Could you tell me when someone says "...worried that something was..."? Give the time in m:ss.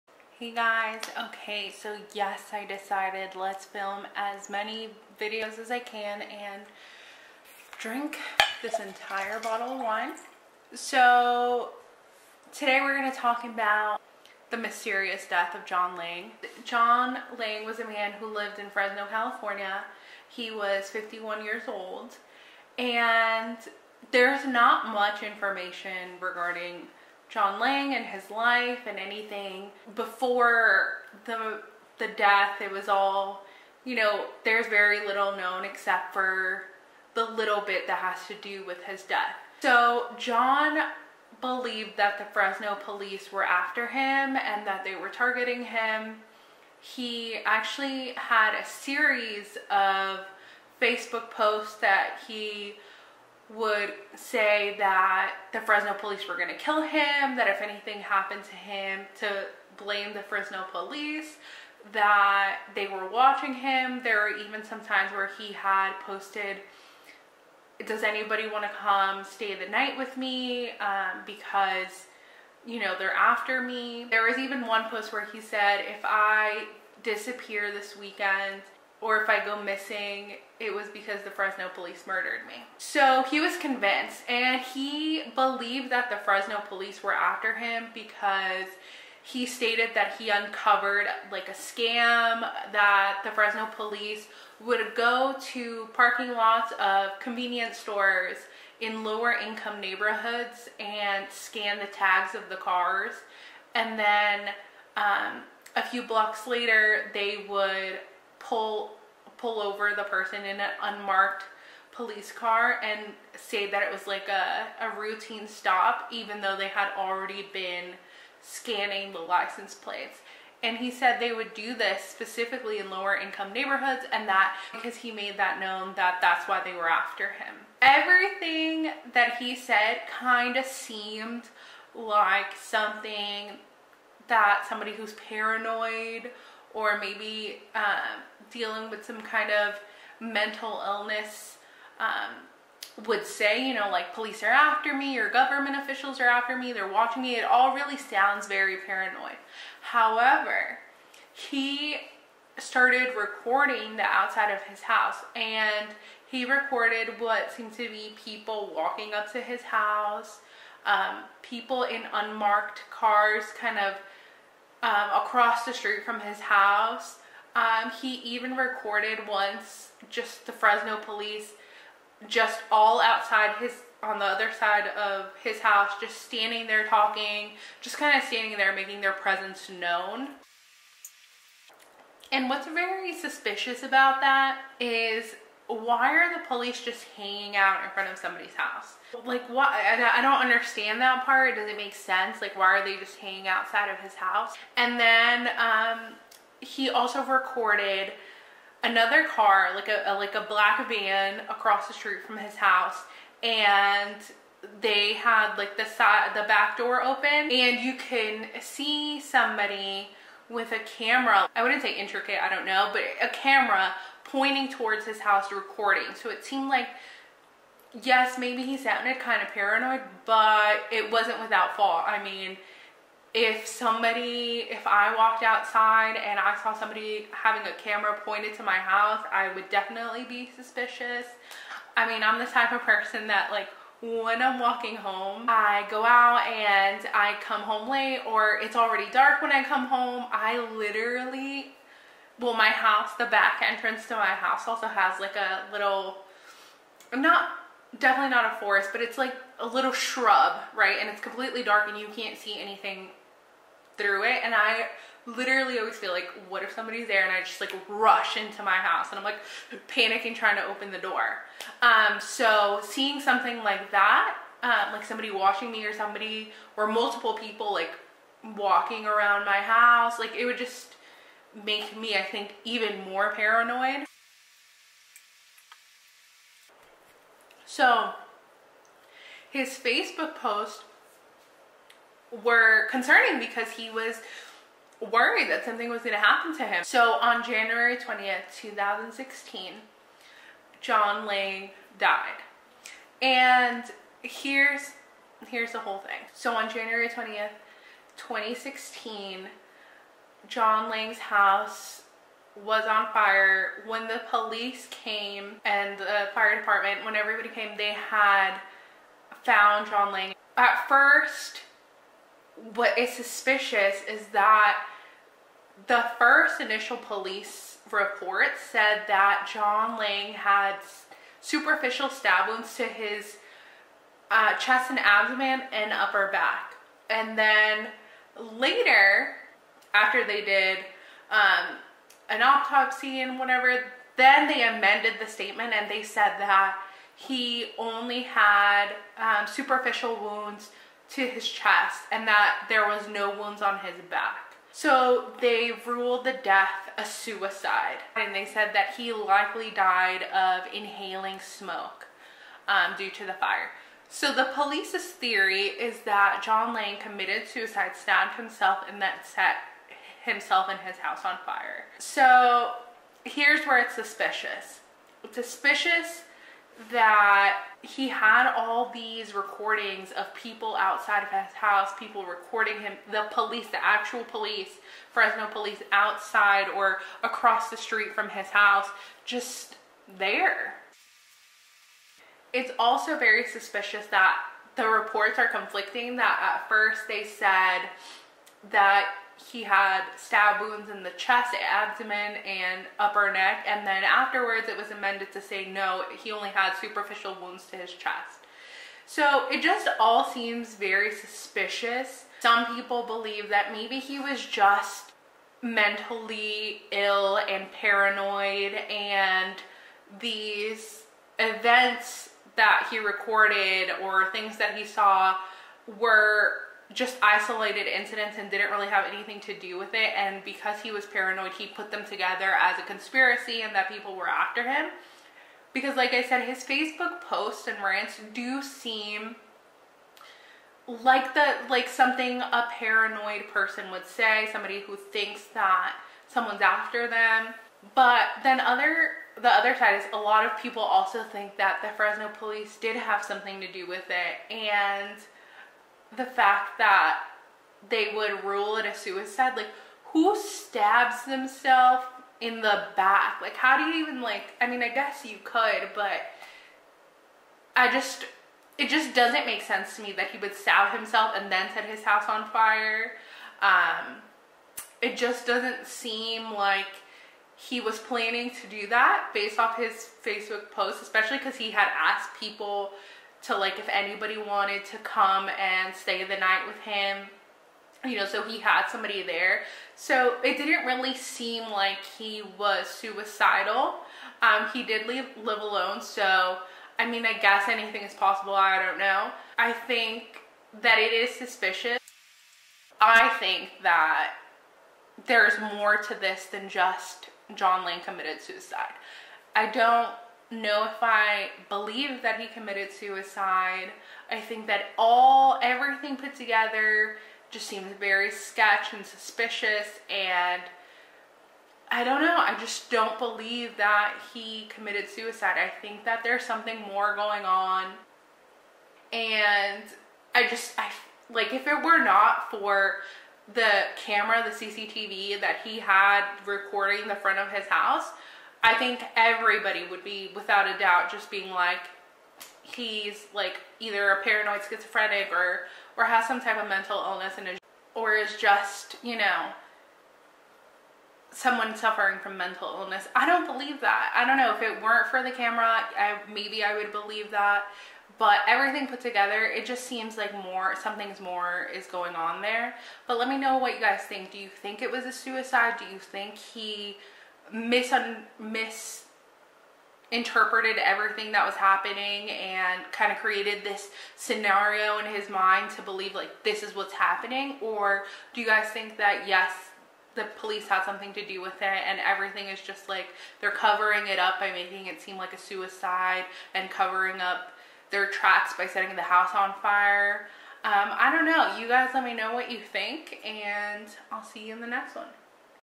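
4:45.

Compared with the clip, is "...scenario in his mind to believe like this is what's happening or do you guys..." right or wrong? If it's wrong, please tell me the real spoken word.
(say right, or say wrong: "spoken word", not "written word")
right.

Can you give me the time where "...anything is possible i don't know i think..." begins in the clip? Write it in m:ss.
8:07.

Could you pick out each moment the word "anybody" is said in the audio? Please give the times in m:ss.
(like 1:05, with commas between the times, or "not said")
1:08, 7:53.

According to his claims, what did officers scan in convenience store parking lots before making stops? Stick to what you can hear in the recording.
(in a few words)
The tags of the cars.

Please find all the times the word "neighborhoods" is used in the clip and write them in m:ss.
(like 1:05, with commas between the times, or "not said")
1:39, 2:03.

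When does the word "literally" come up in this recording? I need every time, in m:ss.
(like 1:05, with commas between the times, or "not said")
4:00, 4:15.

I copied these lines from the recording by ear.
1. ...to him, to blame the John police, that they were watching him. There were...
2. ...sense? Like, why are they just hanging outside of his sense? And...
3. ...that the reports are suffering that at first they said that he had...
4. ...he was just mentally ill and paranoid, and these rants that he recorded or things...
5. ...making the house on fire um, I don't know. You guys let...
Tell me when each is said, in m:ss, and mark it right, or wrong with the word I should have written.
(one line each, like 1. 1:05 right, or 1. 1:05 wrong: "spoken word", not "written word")
1. 0:58 wrong: "Fresno", not "John"
2. 3:11 wrong: "house", not "sense"
3. 6:24 wrong: "conflicting", not "suffering"
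4. 6:43 wrong: "events", not "rants"
5. 9:38 wrong: "setting", not "making".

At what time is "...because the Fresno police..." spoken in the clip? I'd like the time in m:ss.
1:20.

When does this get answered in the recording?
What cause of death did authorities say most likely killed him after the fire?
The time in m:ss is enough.
5:50.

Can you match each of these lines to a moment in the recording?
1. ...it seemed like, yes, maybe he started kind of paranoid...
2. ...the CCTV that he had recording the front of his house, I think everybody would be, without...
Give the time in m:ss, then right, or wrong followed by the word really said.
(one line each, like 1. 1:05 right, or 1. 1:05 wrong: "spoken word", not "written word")
1. 3:36 wrong: "sounded", not "started"
2. 8:44 right.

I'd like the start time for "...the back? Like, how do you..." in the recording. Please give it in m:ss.
7:32.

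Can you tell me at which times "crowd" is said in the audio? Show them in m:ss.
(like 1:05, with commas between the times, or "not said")
not said.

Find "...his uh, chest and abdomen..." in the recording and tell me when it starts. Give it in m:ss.
5:22.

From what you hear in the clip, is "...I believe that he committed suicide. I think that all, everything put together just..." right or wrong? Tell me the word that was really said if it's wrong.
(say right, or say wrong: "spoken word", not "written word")
right.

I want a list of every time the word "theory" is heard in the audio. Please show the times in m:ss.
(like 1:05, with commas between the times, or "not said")
5:55.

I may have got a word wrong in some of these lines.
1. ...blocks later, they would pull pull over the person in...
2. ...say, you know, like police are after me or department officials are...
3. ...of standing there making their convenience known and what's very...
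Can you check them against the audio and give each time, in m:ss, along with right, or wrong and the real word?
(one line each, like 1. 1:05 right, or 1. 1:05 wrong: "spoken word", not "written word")
1. 1:46 right
2. 2:23 wrong: "government", not "department"
3. 2:58 wrong: "presence", not "convenience".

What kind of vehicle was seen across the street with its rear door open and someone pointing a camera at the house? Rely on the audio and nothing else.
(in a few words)
A black van.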